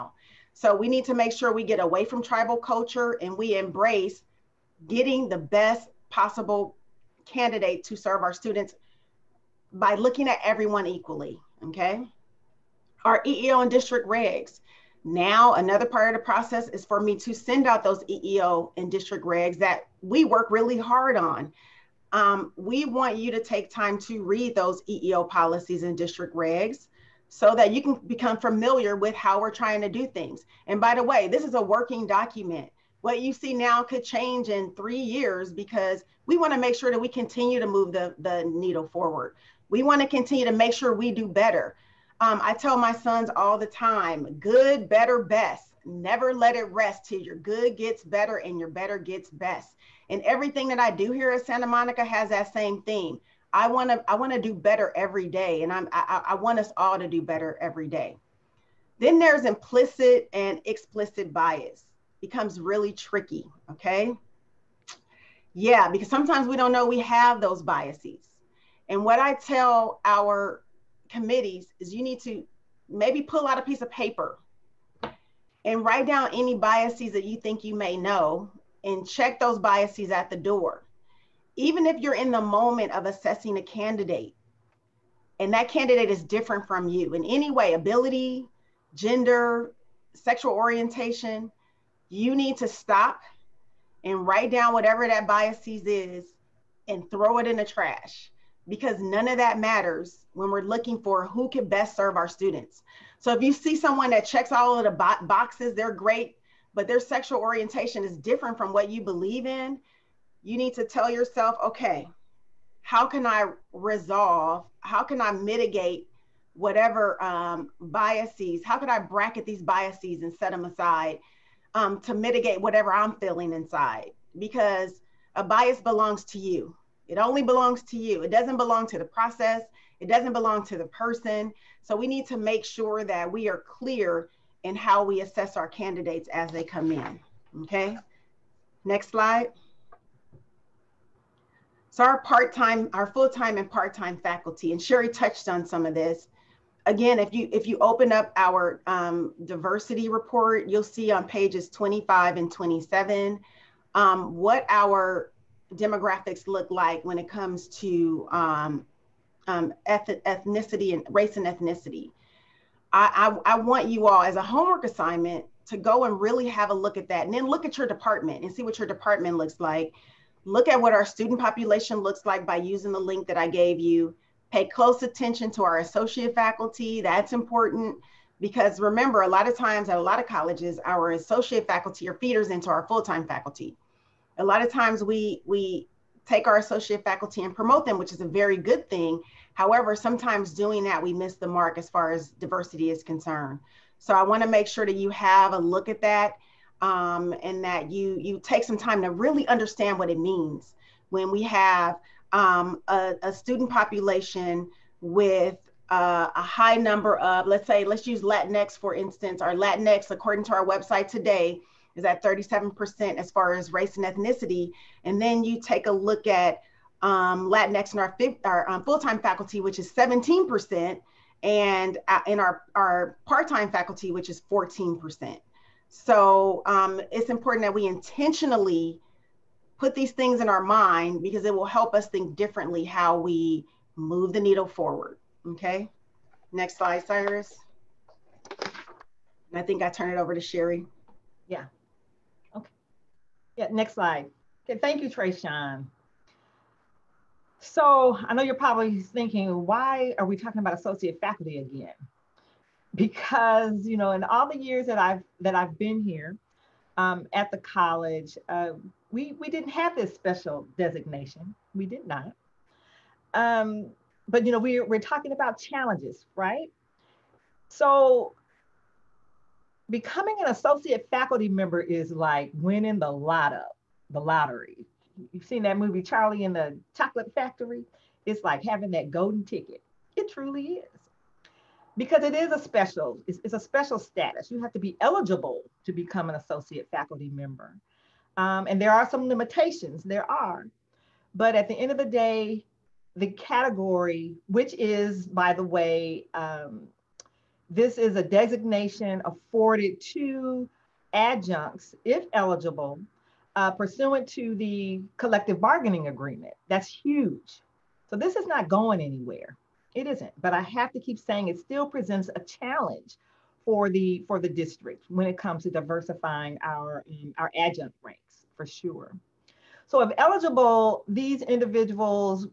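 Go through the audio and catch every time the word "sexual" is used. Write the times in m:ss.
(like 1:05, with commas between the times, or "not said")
1:30, 1:46.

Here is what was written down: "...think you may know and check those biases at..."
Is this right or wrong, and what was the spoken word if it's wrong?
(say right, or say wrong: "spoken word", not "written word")
right.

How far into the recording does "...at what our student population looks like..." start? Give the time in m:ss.
2:50.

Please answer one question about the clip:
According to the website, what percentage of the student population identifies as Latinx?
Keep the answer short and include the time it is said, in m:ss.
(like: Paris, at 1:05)
37%, at 3:32.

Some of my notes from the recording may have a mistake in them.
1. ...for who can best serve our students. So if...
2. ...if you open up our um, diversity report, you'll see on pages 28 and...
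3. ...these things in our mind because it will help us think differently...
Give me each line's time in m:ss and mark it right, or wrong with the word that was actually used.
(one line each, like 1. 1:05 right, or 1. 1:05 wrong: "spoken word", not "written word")
1. 1:41 right
2. 2:27 wrong: "25", not "28"
3. 3:49 right.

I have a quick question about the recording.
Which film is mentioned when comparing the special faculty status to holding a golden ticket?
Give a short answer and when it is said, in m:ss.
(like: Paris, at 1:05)
Charlie in the Chocolate Factory, at 4:36.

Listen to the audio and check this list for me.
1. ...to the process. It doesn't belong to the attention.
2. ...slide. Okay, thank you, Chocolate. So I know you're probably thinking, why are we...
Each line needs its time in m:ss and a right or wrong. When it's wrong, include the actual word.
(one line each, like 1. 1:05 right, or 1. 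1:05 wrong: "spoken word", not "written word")
1. 2:08 wrong: "person", not "attention"
2. 4:03 wrong: "Trayshawn", not "Chocolate".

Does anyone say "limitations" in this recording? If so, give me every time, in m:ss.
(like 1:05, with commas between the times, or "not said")
4:49.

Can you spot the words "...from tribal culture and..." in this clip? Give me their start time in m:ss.
0:02.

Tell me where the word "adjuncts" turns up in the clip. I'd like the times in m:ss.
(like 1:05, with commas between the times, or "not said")
5:01, 5:17.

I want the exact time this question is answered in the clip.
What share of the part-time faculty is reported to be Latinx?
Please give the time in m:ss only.
3:44.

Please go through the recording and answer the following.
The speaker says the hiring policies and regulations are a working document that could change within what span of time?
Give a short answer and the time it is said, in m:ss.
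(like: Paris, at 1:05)
3 years, at 0:34.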